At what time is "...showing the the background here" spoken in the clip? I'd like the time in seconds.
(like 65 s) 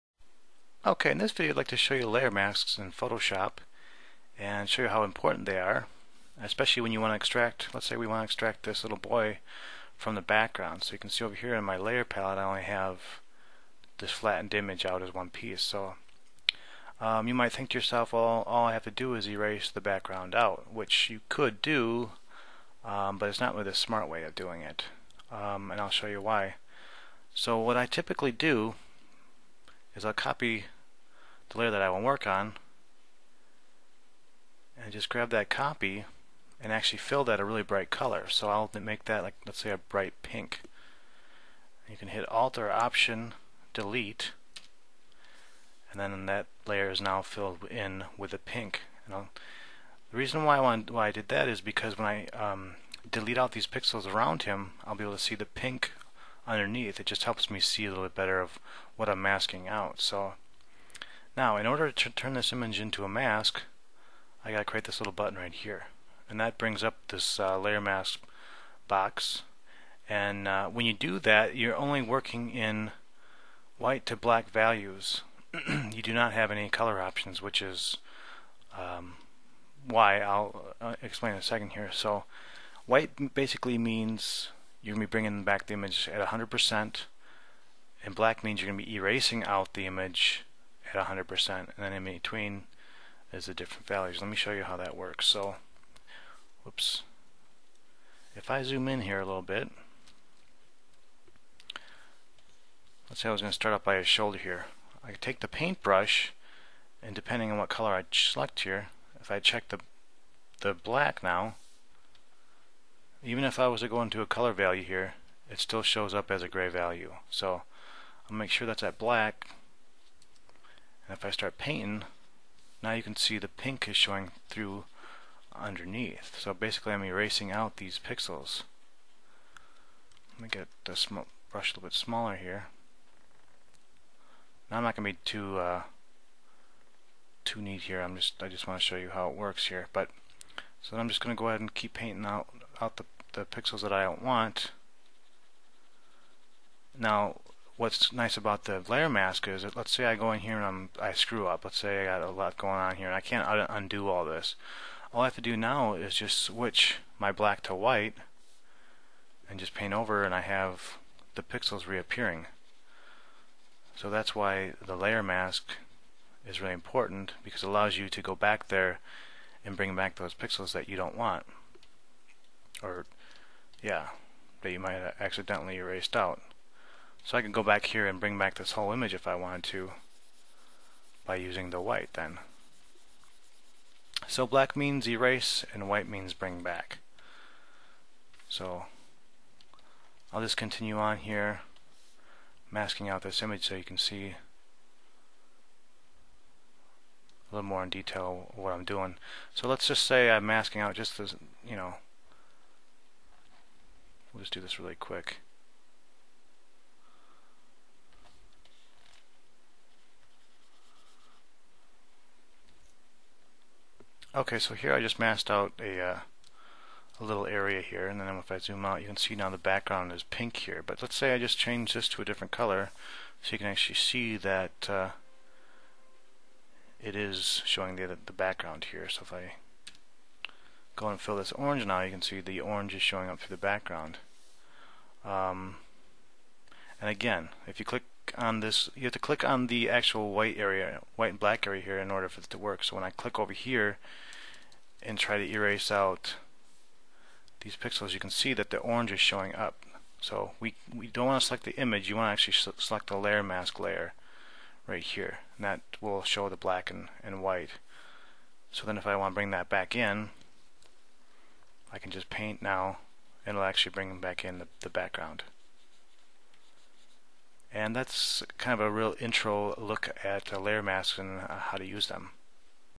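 227 s.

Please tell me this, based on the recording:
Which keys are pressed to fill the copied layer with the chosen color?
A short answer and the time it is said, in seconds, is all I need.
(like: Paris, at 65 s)
Alt or Option Delete, at 42 s.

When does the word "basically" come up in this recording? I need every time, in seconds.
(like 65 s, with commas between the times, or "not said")
83 s, 126 s.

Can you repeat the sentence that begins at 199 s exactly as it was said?
So let's just say I'm masking out just the, you know, We'll just do this really quick.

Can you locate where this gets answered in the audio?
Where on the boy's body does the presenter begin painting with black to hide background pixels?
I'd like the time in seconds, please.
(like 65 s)
103 s.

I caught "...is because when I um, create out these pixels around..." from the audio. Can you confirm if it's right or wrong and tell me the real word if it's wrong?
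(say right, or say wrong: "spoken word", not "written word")
wrong: "delete", not "create".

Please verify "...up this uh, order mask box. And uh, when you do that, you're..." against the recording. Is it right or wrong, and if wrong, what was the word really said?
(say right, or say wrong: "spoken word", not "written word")
wrong: "layer", not "order".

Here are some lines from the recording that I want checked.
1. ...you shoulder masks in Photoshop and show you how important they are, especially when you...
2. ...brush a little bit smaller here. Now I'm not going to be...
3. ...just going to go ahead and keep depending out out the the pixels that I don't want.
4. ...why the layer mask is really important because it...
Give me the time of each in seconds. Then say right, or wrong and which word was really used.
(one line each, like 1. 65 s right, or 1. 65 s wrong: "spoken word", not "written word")
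1. 1 s wrong: "layer", not "shoulder"
2. 131 s right
3. 141 s wrong: "painting", not "depending"
4. 164 s right.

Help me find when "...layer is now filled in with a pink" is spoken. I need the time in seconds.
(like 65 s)
46 s.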